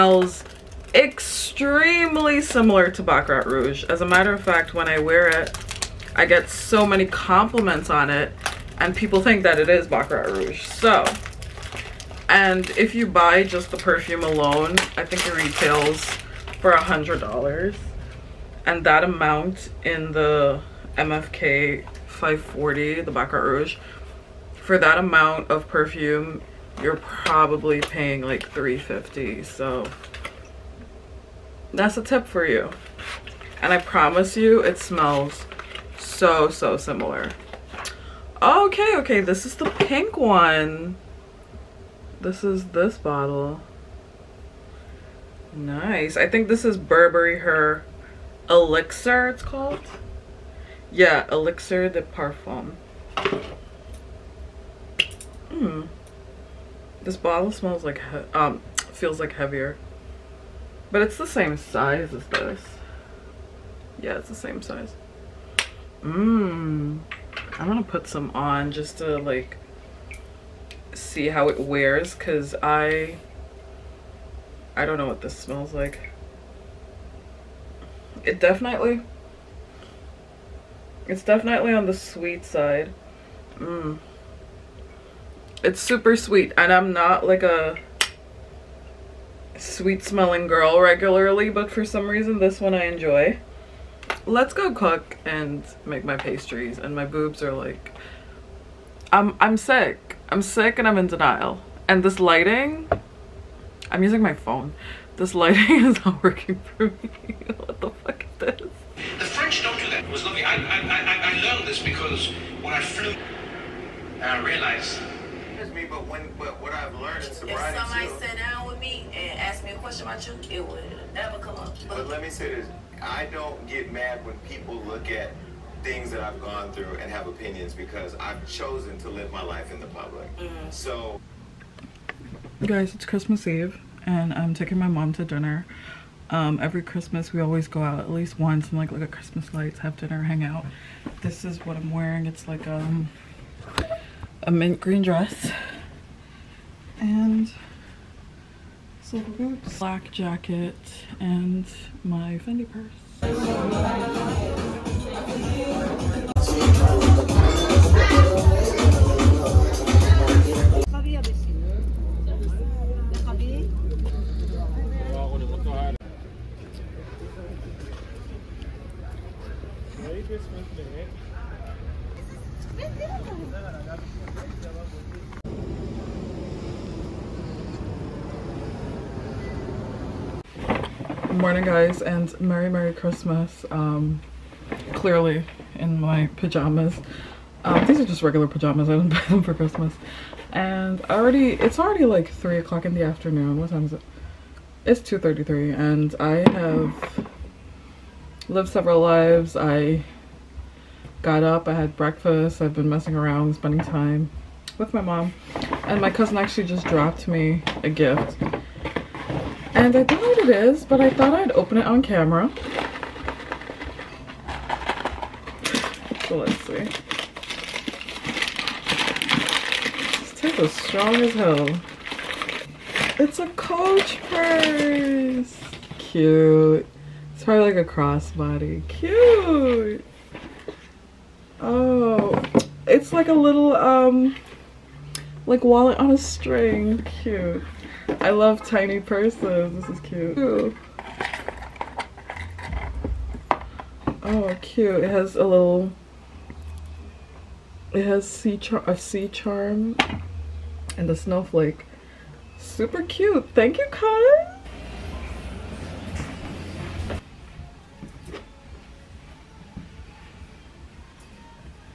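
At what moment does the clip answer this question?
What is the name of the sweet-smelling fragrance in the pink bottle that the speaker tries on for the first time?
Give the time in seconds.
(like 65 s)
46 s.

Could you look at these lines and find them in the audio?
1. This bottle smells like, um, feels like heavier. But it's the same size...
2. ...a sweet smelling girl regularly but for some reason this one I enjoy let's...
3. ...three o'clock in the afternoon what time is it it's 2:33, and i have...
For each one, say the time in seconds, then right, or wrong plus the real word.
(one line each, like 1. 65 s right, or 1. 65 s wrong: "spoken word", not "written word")
1. 57 s right
2. 87 s right
3. 192 s right.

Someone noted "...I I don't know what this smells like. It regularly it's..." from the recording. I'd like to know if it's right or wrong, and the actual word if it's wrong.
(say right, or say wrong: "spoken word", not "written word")
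wrong: "definitely", not "regularly".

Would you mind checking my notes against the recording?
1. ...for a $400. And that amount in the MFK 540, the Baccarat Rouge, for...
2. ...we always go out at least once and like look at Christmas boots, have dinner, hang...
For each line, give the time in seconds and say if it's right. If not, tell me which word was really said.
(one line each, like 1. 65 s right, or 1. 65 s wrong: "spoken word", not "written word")
1. 16 s wrong: "100", not "400"
2. 137 s wrong: "lights", not "boots".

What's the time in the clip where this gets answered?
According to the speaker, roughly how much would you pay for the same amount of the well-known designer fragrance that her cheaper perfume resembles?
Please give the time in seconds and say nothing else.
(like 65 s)
28 s.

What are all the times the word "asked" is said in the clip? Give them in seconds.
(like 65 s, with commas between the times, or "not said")
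119 s.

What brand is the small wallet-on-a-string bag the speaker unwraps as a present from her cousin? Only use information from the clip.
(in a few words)
Coach.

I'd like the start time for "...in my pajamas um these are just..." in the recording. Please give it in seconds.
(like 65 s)
185 s.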